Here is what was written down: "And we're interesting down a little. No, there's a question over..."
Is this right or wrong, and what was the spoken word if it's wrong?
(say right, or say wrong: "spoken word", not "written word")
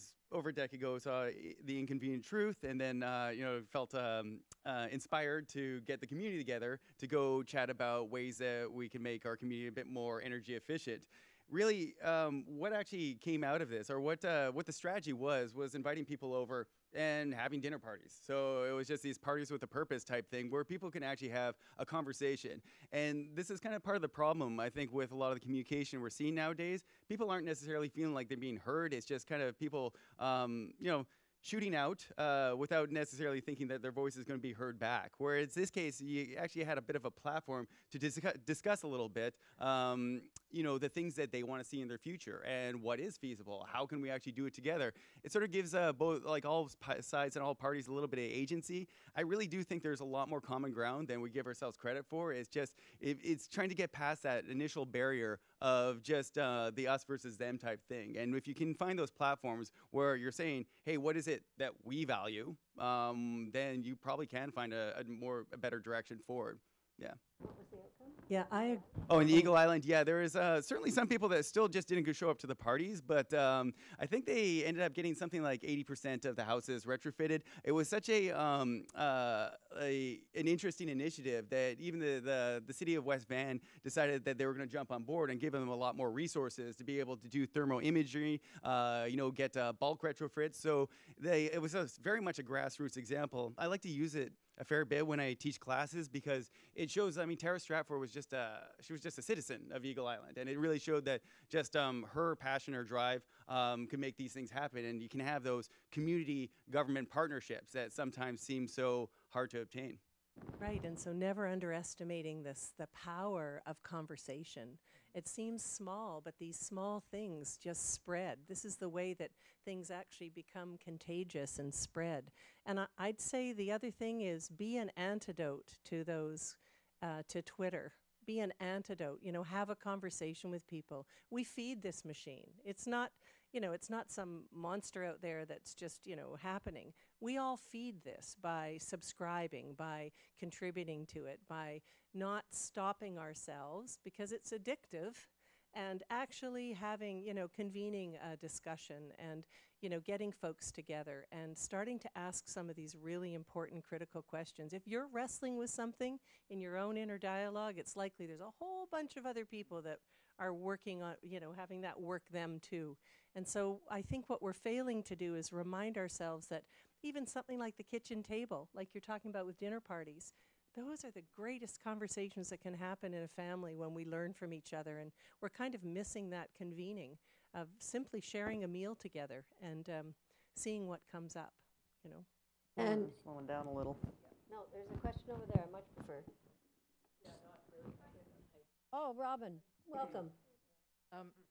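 wrong: "slowing", not "interesting".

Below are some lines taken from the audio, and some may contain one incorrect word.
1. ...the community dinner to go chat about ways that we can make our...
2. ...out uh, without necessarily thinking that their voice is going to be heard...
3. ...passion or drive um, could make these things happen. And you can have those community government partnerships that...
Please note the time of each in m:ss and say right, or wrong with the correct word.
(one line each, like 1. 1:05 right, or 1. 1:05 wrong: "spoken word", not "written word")
1. 0:05 wrong: "together", not "dinner"
2. 0:31 right
3. 1:42 right.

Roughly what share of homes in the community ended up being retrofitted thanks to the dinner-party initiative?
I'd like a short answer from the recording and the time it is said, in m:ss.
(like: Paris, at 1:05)
80%, at 1:15.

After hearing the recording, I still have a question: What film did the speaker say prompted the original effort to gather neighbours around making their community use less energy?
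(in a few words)
The Inconvenient Truth.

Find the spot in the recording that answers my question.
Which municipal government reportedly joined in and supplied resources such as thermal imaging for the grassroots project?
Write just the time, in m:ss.
1:23.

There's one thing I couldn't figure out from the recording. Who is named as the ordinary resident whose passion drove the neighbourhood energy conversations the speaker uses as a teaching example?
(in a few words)
Tara Stratford.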